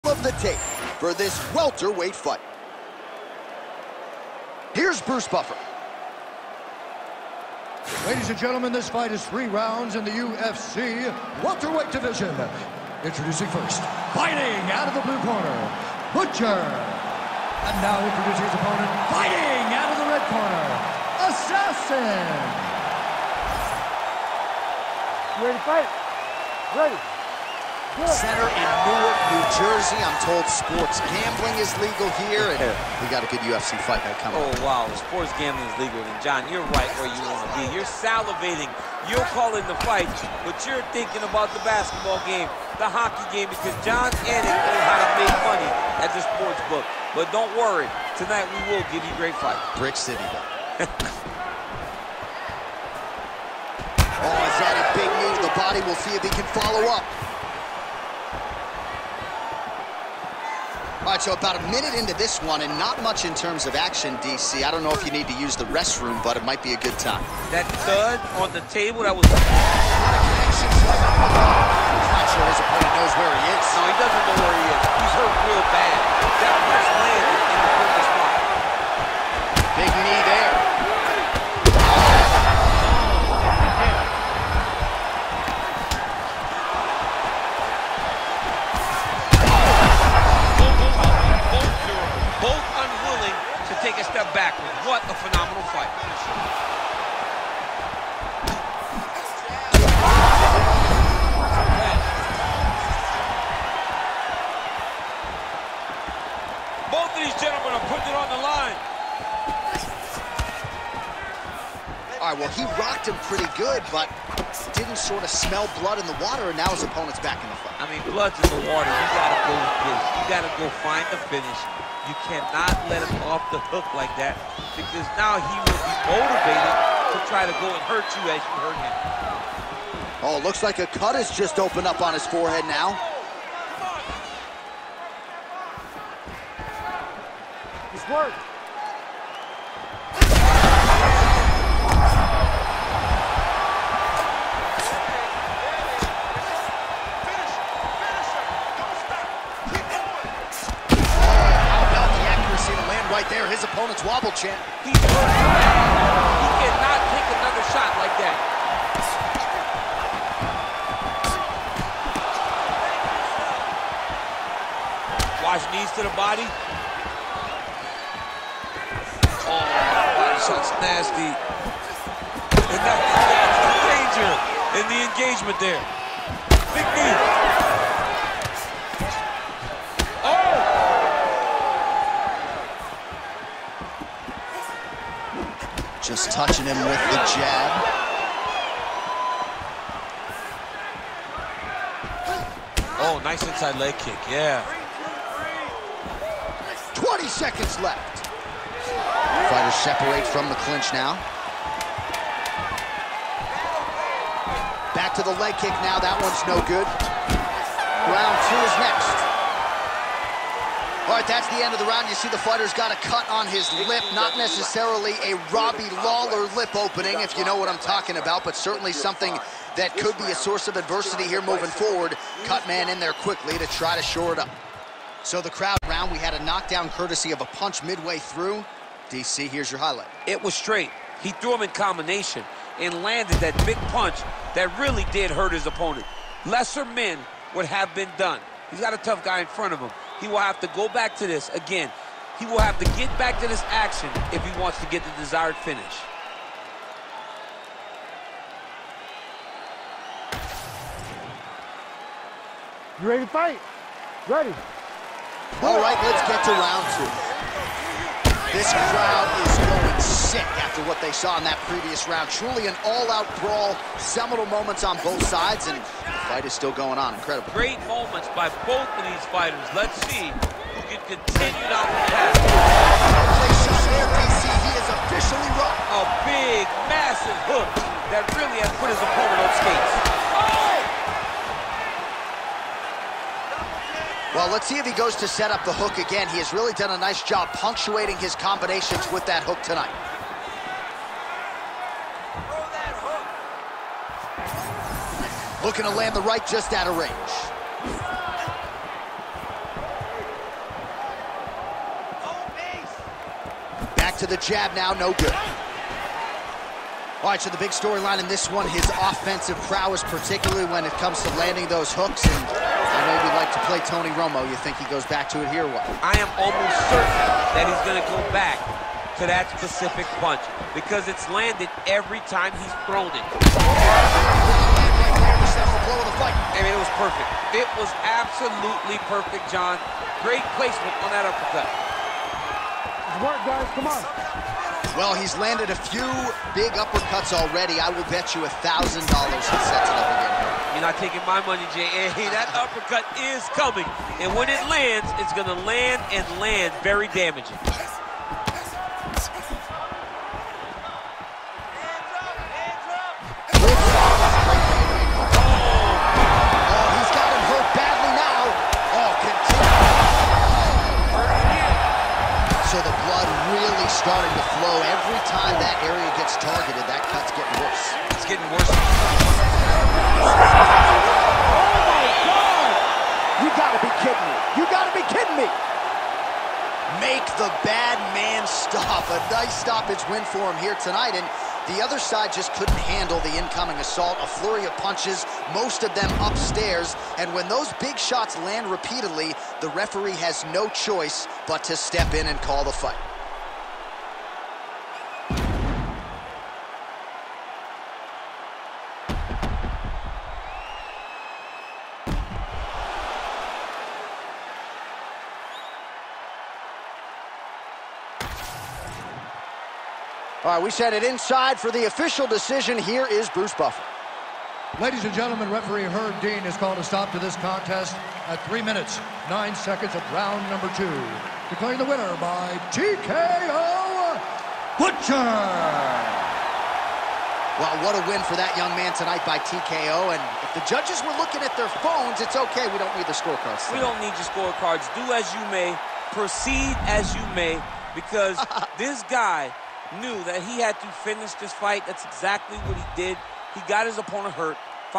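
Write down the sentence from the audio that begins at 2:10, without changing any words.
Oh, looks like a cut has just opened up on his forehead now.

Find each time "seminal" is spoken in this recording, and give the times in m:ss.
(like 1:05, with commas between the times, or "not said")
4:23.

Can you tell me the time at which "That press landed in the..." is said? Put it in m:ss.
1:16.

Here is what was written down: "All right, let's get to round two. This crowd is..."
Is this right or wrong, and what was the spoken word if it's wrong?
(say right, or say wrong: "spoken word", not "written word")
right.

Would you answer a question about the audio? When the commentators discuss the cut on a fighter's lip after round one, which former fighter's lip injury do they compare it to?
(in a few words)
Robbie Lawler.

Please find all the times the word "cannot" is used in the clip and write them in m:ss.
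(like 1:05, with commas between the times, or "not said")
2:02, 2:36.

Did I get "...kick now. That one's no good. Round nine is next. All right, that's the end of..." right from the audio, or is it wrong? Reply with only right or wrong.
wrong.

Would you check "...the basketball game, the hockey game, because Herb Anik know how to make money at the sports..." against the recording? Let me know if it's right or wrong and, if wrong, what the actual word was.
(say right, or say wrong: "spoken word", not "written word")
wrong: "Jon", not "Herb".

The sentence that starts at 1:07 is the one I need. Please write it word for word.
That thud on the table, that was...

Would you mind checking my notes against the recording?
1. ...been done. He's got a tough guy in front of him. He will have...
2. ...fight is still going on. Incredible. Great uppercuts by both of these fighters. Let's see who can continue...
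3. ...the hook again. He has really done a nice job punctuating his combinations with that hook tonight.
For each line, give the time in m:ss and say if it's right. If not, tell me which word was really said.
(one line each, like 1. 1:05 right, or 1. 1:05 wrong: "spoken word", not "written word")
1. 3:57 right
2. 4:26 wrong: "moments", not "uppercuts"
3. 4:45 right.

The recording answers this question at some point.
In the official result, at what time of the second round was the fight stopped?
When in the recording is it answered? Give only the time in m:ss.
6:58.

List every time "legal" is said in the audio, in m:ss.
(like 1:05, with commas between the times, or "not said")
0:31, 0:35.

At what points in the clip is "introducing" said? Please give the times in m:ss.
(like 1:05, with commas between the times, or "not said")
0:13, 0:17.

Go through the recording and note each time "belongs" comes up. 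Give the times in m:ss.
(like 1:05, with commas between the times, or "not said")
not said.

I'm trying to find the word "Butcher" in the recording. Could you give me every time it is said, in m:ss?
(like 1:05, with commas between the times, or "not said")
0:16, 7:04.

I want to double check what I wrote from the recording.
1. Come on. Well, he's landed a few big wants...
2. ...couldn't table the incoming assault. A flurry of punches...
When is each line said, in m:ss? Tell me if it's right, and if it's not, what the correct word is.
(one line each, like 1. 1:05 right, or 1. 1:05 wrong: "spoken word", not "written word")
1. 5:33 wrong: "uppercuts", not "wants"
2. 6:22 wrong: "handle", not "table".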